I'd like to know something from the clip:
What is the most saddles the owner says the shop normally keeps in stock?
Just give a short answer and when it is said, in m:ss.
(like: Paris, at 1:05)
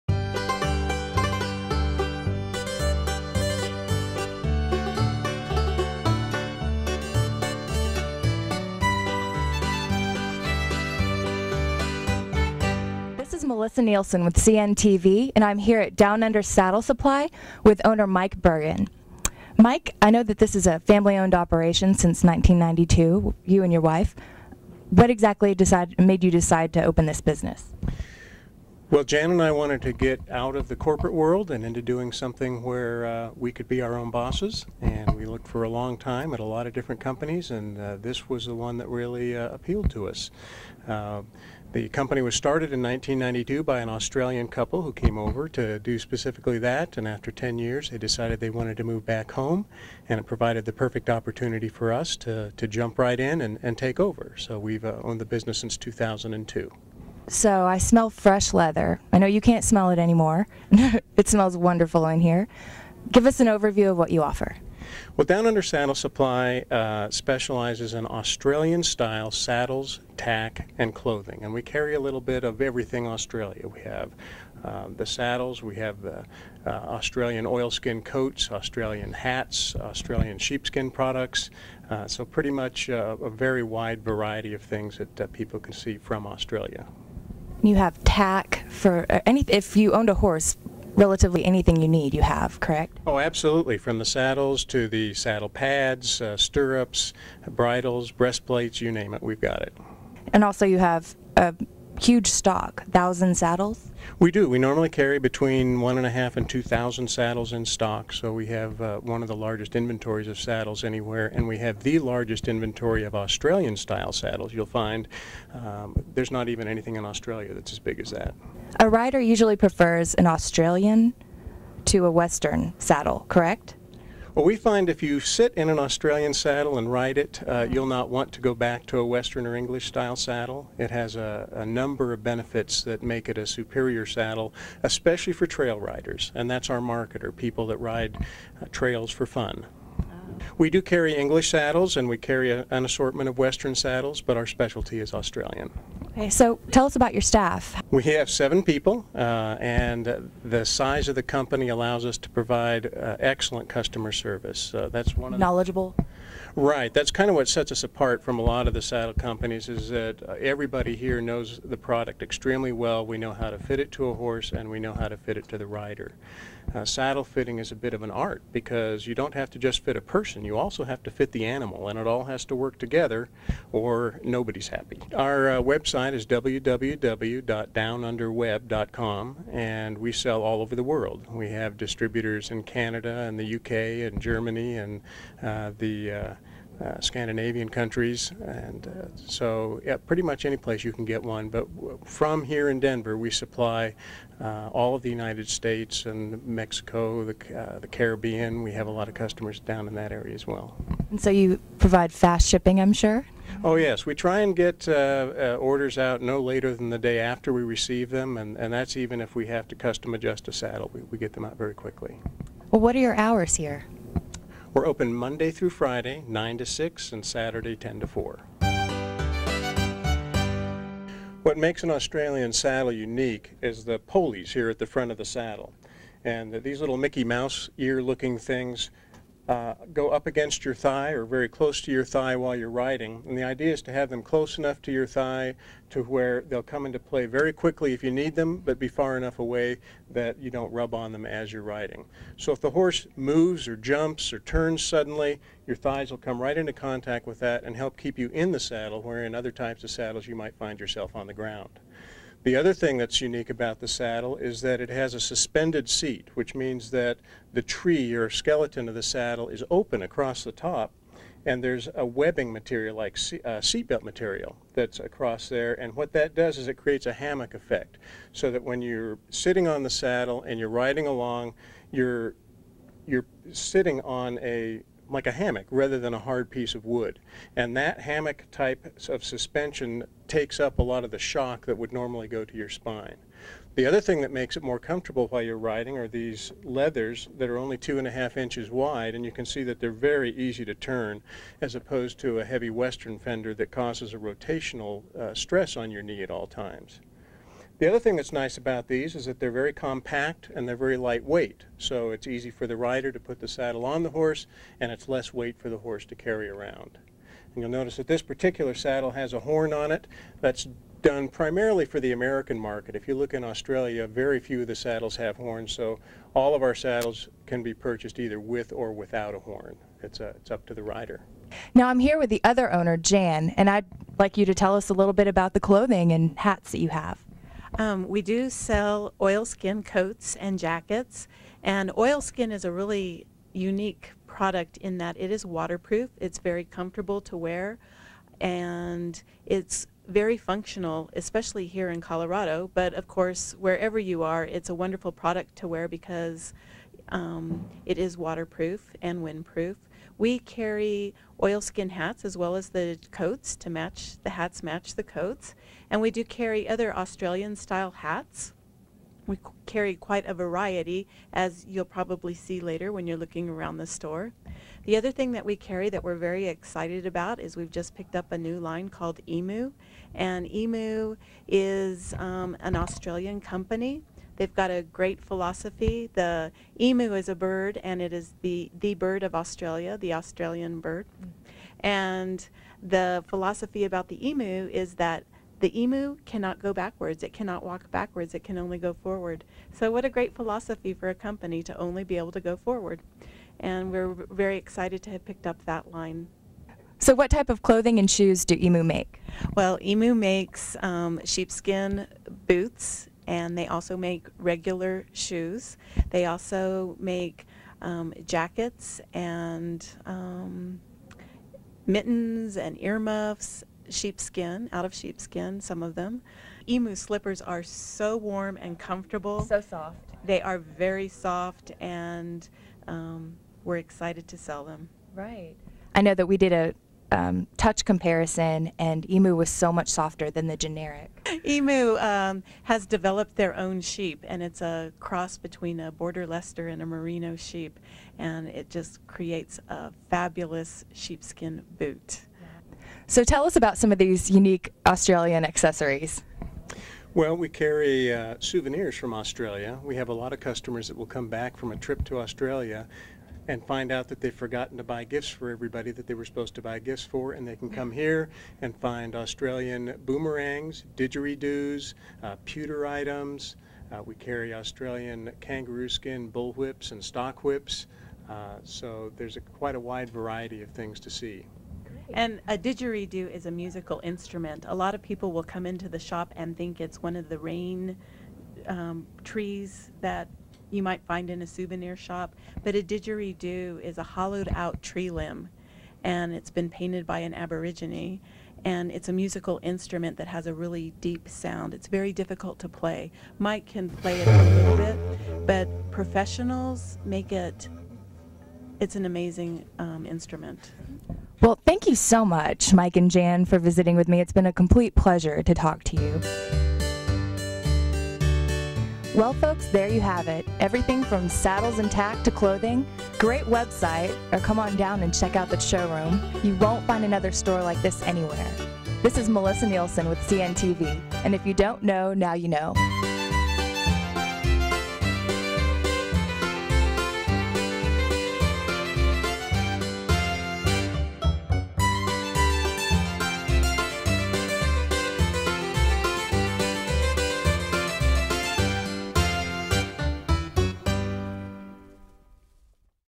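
2,000, at 1:46.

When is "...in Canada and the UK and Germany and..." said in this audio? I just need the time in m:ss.
3:02.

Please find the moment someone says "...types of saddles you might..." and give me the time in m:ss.
4:09.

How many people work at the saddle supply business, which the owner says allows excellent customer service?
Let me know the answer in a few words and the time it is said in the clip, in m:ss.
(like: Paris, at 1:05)
7, at 2:28.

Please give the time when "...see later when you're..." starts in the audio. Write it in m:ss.
6:02.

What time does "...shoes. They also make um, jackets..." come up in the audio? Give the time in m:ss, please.
6:45.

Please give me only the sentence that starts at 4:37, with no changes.
And that hammock type of suspension takes up a lot of the shock that would normally go to your spine.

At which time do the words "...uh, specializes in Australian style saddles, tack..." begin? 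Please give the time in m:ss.
1:06.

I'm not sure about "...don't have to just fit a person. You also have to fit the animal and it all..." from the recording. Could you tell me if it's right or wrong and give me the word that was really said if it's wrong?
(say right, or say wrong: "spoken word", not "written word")
right.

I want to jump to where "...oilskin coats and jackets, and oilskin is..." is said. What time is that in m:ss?
5:29.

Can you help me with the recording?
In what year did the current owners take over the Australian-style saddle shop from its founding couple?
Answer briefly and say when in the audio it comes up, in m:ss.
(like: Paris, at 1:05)
2002, at 0:55.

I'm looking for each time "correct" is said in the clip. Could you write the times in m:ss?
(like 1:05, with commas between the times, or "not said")
1:32, 2:03.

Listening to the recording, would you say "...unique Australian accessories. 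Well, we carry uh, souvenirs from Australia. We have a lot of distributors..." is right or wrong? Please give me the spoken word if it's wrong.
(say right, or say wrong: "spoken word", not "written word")
wrong: "customers", not "distributors".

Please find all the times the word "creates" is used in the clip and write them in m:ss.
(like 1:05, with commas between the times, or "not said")
4:26, 7:19.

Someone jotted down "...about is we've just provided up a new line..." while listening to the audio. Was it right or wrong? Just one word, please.
wrong.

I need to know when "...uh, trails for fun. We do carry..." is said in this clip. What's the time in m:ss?
2:18.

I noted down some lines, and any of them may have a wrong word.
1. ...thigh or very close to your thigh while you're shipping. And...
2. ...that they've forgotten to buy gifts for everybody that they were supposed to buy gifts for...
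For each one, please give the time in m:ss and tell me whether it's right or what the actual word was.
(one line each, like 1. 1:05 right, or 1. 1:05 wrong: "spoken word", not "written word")
1. 3:50 wrong: "riding", not "shipping"
2. 7:34 right.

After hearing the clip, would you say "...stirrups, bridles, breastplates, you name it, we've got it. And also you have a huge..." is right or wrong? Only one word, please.
right.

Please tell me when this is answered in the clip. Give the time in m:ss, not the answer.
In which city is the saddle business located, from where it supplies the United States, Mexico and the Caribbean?
3:12.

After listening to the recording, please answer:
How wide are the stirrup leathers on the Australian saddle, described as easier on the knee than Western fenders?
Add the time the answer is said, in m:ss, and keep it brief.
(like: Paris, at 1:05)
2.5 inches, at 4:47.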